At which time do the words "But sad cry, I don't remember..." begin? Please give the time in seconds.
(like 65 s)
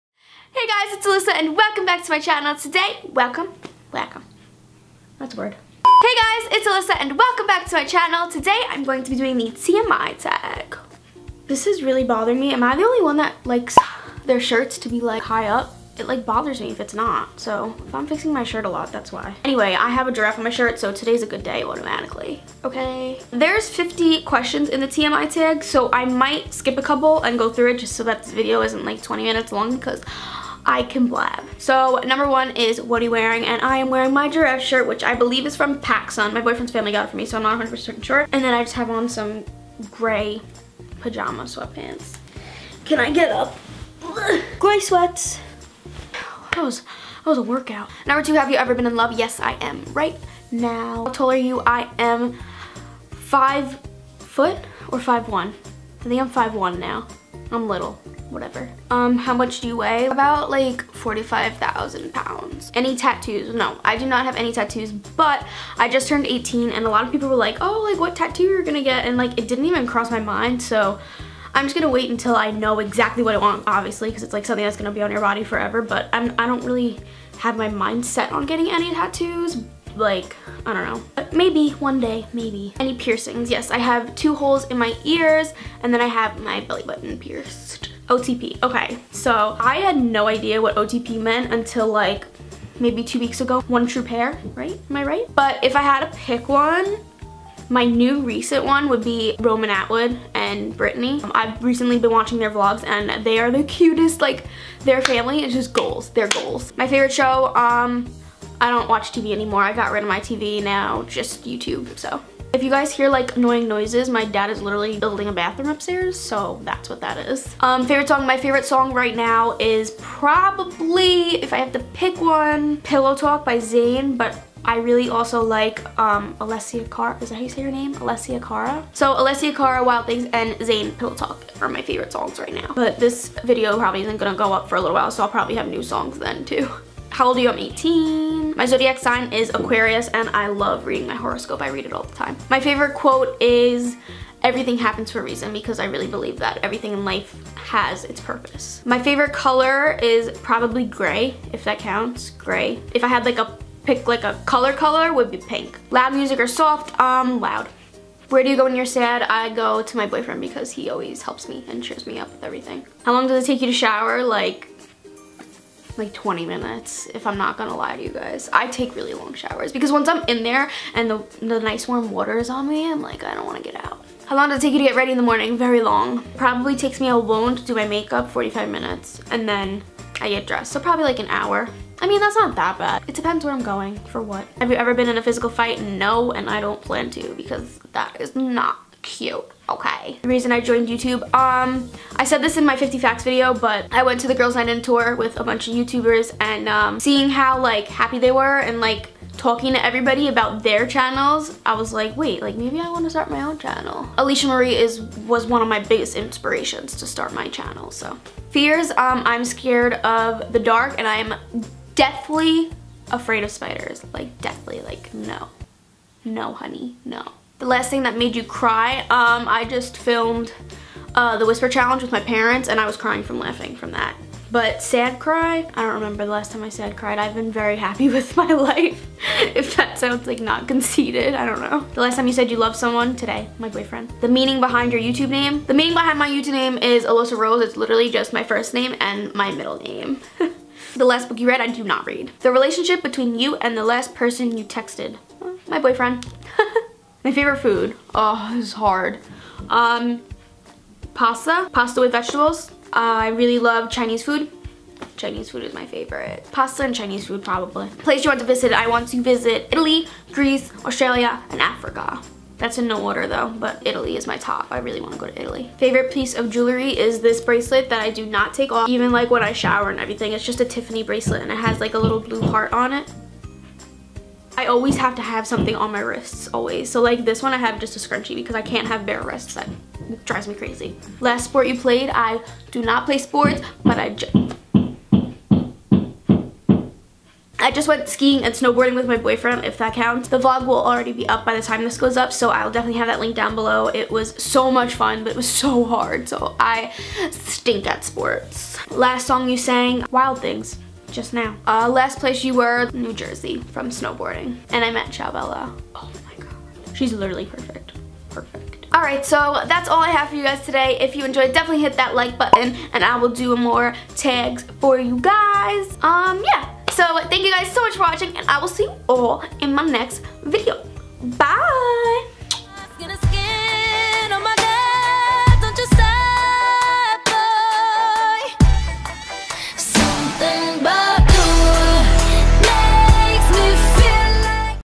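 224 s.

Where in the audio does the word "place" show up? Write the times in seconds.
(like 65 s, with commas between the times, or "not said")
257 s, 302 s.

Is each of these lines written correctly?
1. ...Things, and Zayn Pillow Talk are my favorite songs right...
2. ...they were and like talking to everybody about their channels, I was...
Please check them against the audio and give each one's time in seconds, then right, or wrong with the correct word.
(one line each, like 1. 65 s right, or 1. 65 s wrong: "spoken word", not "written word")
1. 130 s right
2. 198 s right.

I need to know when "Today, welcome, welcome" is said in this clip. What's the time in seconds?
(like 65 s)
2 s.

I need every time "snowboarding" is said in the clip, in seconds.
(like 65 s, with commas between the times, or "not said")
288 s, 303 s.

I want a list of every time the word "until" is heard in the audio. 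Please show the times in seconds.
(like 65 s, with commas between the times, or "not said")
72 s, 91 s.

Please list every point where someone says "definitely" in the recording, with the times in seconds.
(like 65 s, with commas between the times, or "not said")
292 s, 311 s.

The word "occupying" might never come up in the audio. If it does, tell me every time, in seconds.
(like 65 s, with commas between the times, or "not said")
not said.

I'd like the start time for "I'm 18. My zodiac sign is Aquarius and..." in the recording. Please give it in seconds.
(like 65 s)
137 s.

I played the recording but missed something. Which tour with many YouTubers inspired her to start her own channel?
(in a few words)
Girls Night In tour.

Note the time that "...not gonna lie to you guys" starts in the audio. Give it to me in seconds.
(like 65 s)
167 s.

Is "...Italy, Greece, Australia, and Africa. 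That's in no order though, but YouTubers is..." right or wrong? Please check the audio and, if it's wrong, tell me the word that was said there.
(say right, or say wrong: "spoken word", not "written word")
wrong: "Italy", not "YouTubers".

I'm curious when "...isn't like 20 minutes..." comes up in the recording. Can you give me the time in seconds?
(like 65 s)
28 s.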